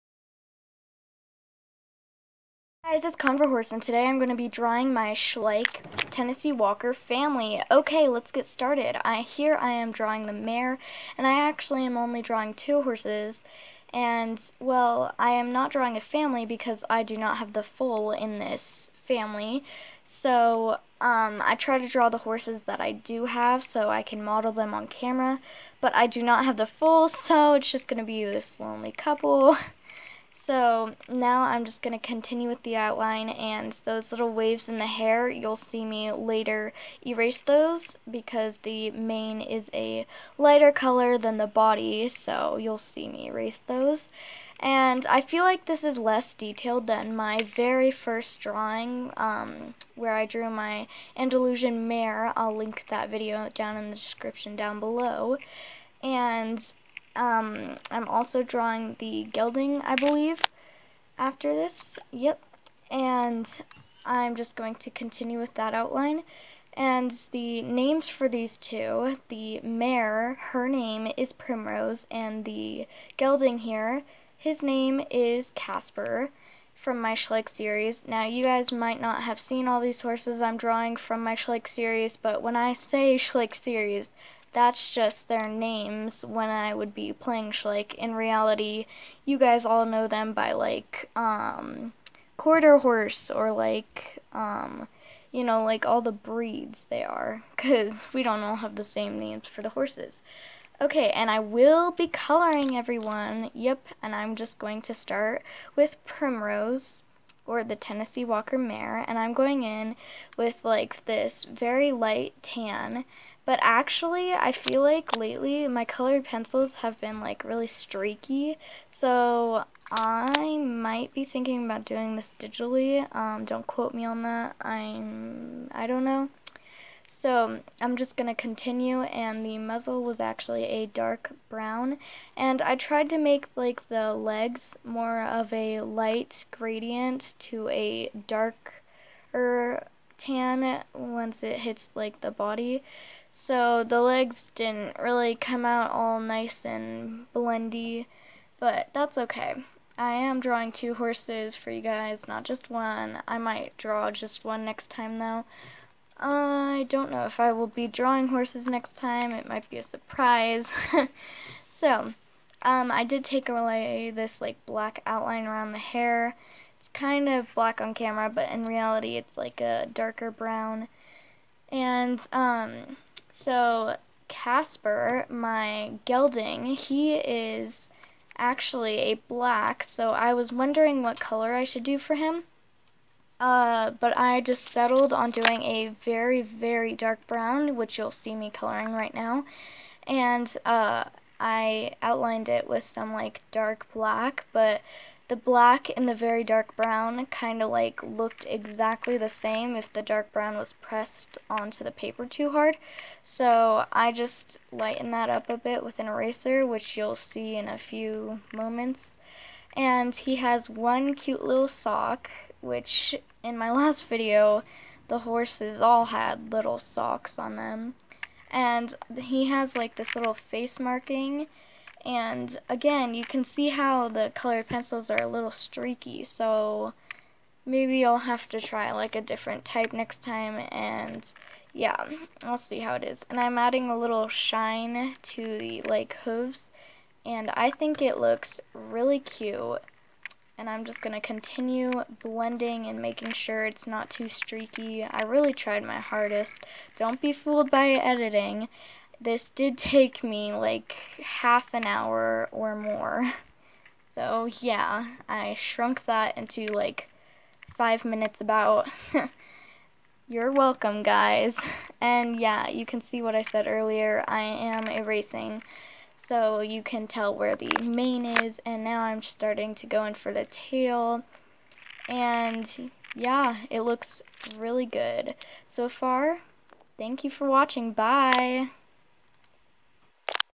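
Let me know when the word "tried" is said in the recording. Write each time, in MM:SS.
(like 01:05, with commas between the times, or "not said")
02:12, 04:05.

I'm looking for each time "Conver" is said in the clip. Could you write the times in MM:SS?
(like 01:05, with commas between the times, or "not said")
00:03.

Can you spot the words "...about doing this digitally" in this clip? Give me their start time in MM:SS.
02:01.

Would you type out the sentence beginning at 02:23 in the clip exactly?
So the legs didn't really come out all nice and blendy, but that's okay.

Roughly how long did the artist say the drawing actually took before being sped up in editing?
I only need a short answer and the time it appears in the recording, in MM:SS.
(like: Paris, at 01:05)
half an hour, at 04:11.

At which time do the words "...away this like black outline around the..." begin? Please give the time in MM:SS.
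02:43.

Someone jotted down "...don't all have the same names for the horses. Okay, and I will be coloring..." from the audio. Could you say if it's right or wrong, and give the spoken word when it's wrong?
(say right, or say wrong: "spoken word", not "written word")
right.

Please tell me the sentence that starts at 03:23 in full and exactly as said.
So I just lightened that up a bit with an eraser, which you'll see in a few moments.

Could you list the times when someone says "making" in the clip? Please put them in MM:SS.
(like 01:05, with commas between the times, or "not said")
04:03.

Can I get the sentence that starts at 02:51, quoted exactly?
And um, so Casper, my gelding, he is actually a black, so I was wondering what color I should do for him.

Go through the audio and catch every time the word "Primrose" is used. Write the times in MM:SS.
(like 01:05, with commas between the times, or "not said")
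01:11, 01:46.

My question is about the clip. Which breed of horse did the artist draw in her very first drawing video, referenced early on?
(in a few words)
Andalusian.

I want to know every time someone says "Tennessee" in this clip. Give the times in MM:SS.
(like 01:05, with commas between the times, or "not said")
00:06, 01:47.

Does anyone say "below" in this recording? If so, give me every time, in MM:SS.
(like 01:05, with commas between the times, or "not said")
00:54.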